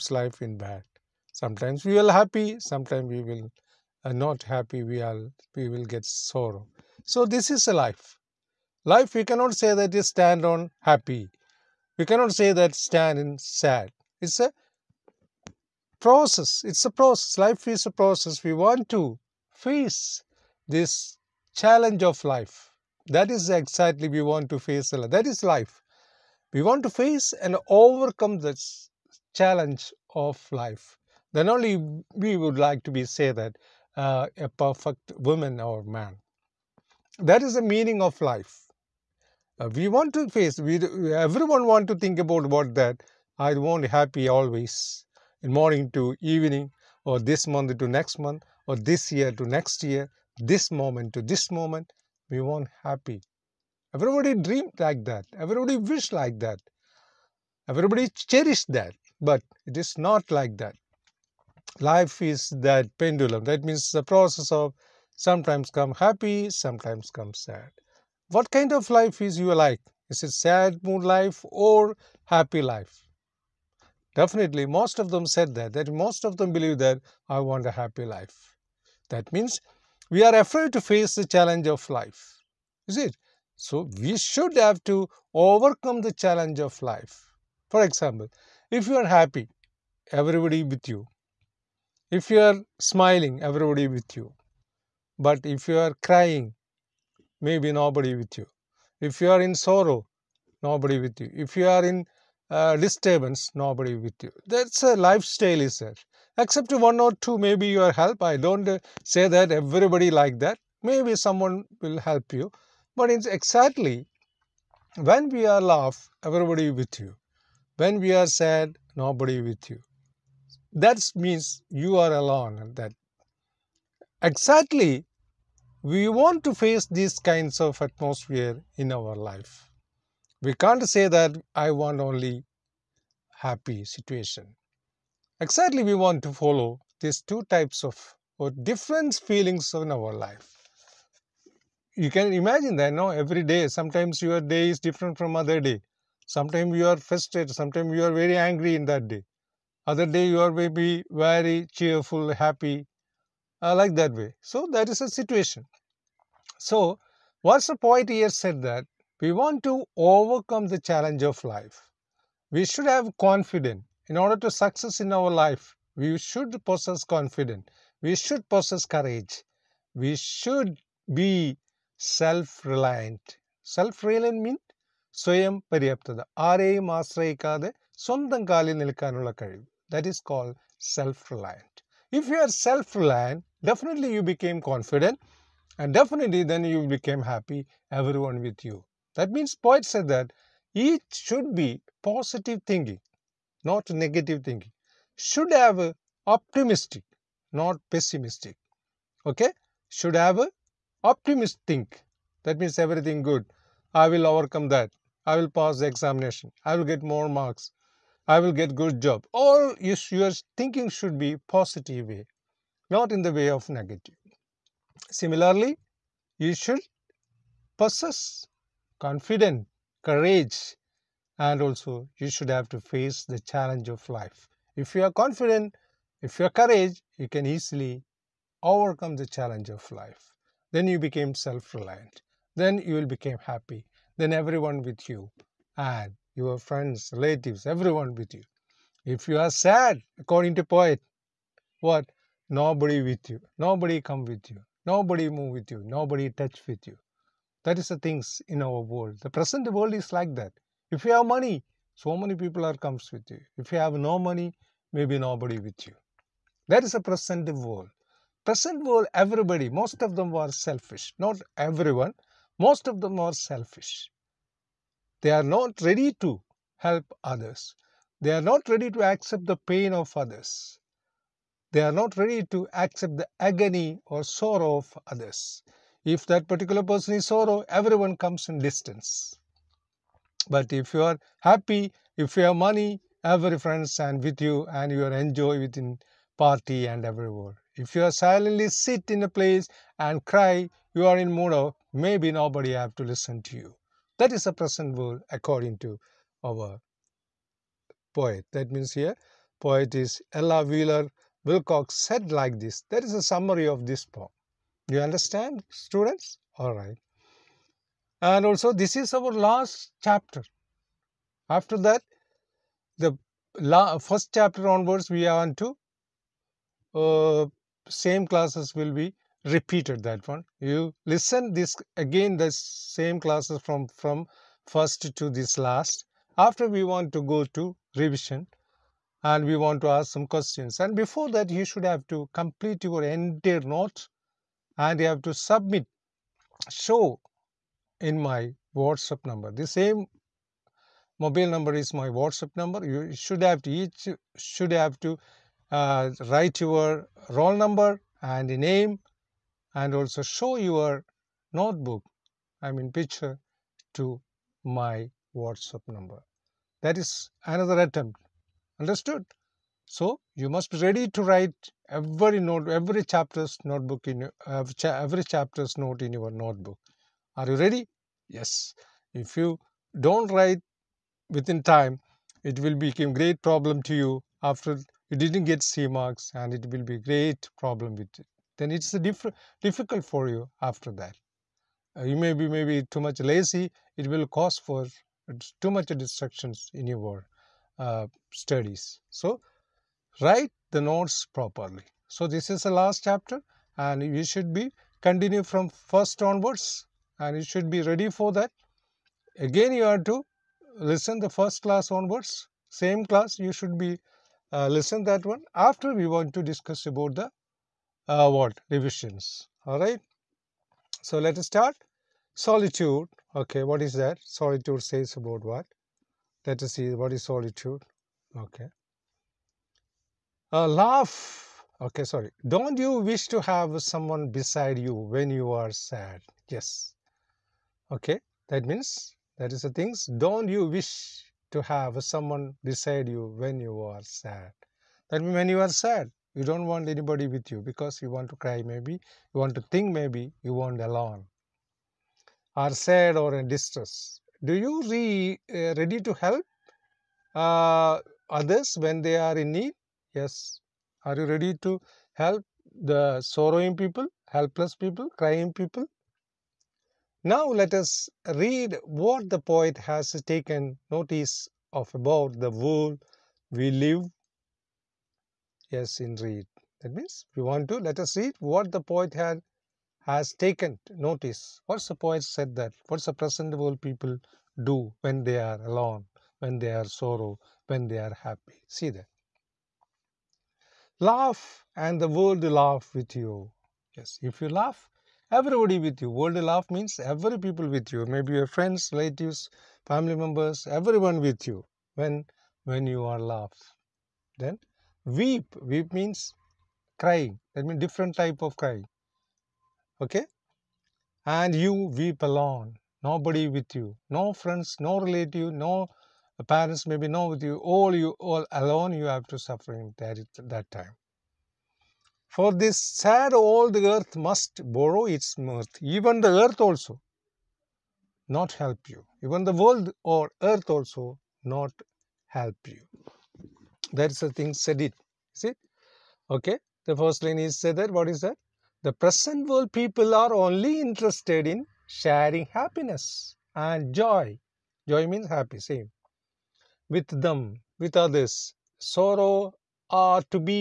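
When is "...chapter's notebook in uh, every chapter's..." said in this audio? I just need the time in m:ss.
6:03.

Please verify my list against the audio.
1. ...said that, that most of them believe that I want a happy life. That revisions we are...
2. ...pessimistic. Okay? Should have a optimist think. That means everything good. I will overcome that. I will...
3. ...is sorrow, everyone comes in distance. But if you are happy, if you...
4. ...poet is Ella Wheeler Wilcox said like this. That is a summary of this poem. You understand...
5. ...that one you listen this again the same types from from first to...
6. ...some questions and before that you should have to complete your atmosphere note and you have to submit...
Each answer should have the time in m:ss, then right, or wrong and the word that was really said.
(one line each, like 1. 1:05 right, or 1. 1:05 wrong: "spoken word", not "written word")
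1. 1:15 wrong: "means", not "revisions"
2. 3:17 right
3. 4:37 right
4. 4:59 right
5. 5:20 wrong: "classes", not "types"
6. 5:30 wrong: "entire", not "atmosphere".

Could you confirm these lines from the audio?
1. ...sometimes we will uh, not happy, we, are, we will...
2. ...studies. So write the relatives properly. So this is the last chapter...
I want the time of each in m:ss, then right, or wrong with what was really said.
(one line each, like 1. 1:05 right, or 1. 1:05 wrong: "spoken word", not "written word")
1. 0:02 right
2. 6:28 wrong: "nodes", not "relatives".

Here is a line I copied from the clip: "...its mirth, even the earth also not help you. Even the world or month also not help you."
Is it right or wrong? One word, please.
wrong.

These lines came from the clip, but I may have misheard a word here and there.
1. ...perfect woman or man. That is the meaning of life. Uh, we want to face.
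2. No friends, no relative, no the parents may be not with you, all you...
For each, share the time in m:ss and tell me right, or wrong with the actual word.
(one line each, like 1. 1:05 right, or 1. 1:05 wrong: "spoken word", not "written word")
1. 0:34 right
2. 8:24 right.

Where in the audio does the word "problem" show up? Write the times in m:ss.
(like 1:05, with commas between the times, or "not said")
6:13, 6:17.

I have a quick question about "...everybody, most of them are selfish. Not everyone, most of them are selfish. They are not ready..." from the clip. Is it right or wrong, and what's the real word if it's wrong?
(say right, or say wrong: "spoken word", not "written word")
right.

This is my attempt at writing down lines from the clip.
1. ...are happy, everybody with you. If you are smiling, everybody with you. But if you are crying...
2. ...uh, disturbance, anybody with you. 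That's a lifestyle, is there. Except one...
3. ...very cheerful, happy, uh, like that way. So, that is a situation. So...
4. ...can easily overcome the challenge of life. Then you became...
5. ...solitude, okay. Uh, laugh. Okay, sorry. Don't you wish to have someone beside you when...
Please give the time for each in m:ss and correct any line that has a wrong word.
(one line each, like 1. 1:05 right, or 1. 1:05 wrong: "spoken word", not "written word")
1. 1:28 right
2. 1:42 wrong: "nobody", not "anybody"
3. 2:31 right
4. 3:47 right
5. 6:57 right.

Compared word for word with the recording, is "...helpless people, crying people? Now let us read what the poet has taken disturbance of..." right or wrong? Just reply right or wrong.
wrong.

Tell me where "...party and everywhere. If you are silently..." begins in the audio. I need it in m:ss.
4:46.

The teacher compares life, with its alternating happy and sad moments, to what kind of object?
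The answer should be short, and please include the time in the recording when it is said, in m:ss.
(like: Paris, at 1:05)
Pendulum, at 1:02.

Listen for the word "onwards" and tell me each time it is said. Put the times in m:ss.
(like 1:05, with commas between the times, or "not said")
5:14, 6:36, 6:41.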